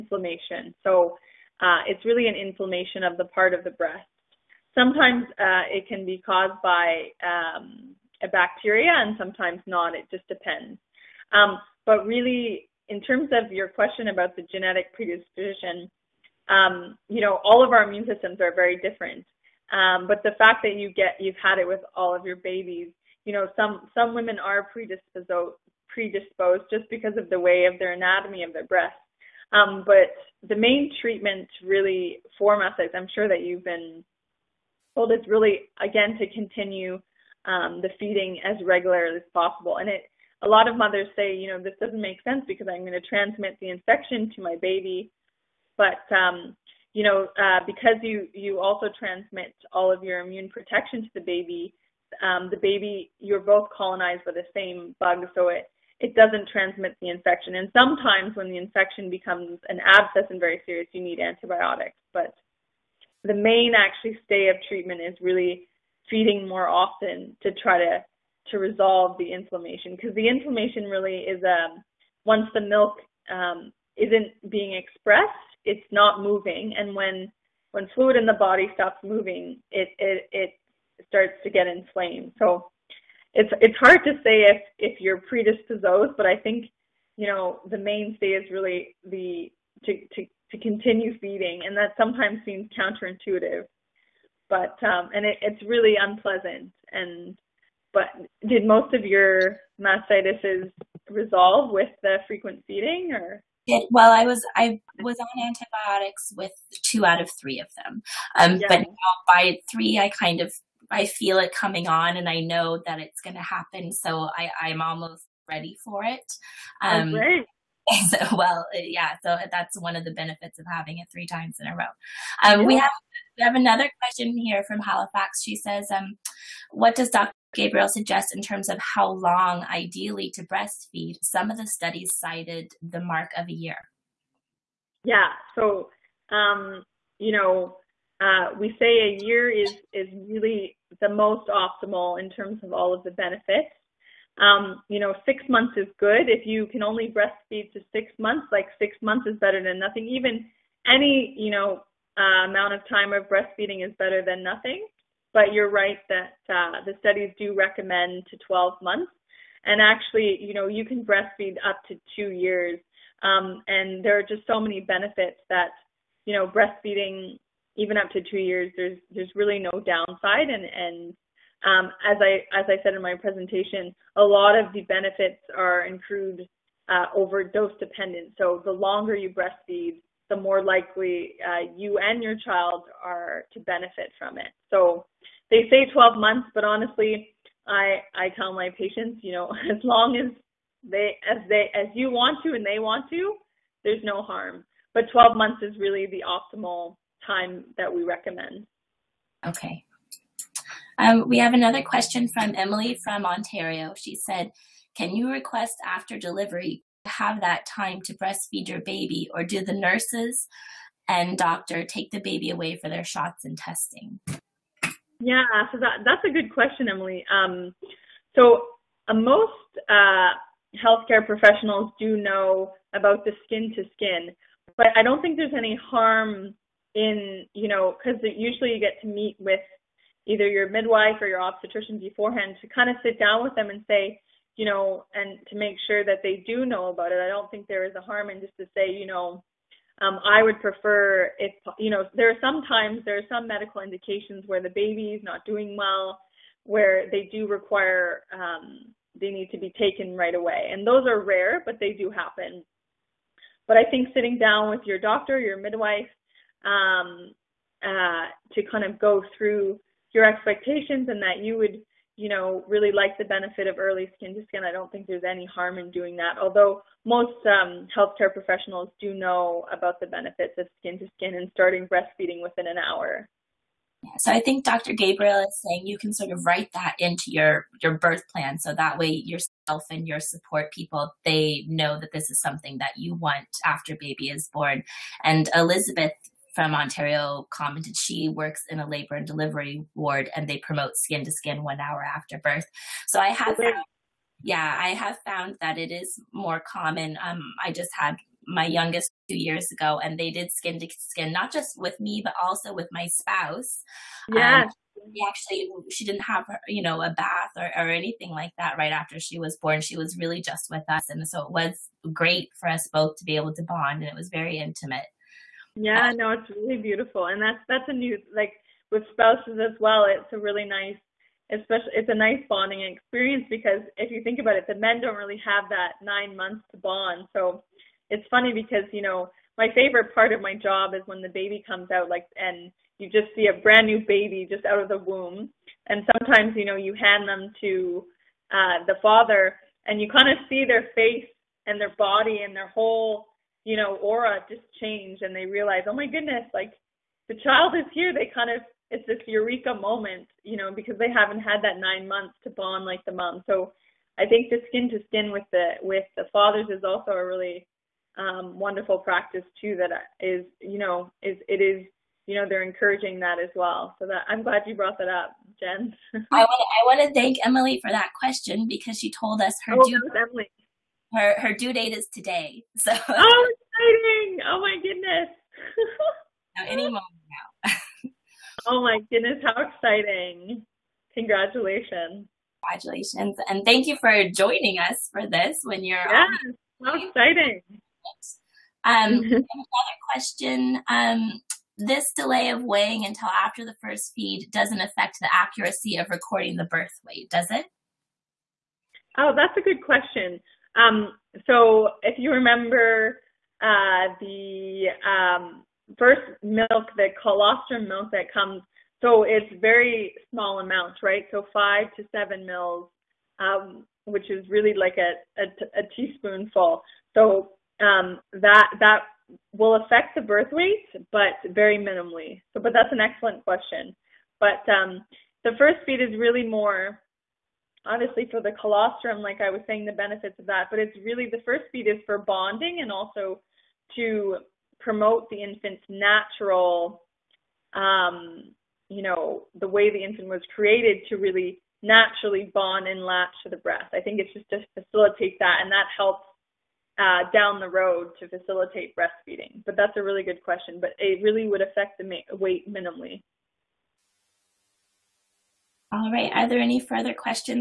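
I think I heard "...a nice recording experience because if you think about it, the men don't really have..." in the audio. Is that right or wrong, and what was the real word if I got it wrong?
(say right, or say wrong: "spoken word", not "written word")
wrong: "bonding", not "recording".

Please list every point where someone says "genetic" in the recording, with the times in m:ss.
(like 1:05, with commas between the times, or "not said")
0:14.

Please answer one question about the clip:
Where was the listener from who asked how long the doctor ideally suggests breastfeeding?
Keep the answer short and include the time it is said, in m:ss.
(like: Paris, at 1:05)
Halifax, at 2:04.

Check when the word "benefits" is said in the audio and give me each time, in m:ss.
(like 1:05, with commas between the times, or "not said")
2:00, 2:23, 2:44, 2:54, 3:03, 4:23, 4:30, 7:09.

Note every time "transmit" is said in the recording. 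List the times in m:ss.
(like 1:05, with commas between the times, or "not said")
0:42, 0:48, 0:56.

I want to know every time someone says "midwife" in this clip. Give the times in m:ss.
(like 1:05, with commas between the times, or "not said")
3:50, 4:15.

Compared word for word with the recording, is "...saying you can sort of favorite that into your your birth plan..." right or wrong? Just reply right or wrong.
wrong.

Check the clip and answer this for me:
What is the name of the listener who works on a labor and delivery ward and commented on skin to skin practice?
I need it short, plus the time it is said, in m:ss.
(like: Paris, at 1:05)
Elizabeth, at 4:45.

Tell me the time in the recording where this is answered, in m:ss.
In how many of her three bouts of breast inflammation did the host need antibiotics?
1:46.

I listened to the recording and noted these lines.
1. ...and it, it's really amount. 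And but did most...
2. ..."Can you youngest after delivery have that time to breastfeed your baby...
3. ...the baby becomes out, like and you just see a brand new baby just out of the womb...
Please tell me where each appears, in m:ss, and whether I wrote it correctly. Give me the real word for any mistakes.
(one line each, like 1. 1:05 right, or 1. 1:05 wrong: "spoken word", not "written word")
1. 1:35 wrong: "unpleasant", not "amount"
2. 3:24 wrong: "request", not "youngest"
3. 5:31 wrong: "comes", not "becomes".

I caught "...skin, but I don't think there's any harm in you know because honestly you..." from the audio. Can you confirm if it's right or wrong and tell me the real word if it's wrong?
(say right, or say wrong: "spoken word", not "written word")
wrong: "usually", not "honestly".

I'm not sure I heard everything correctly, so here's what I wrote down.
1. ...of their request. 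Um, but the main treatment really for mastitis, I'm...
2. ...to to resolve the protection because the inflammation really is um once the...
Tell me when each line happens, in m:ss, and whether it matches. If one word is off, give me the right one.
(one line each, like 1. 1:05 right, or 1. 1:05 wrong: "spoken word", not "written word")
1. 0:28 wrong: "breast", not "request"
2. 1:07 wrong: "inflammation", not "protection".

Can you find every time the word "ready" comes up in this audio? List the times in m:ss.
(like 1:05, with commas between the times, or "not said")
1:55.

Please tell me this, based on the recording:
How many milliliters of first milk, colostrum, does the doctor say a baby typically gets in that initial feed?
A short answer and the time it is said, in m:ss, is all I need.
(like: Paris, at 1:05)
5 to 7 mL, at 6:51.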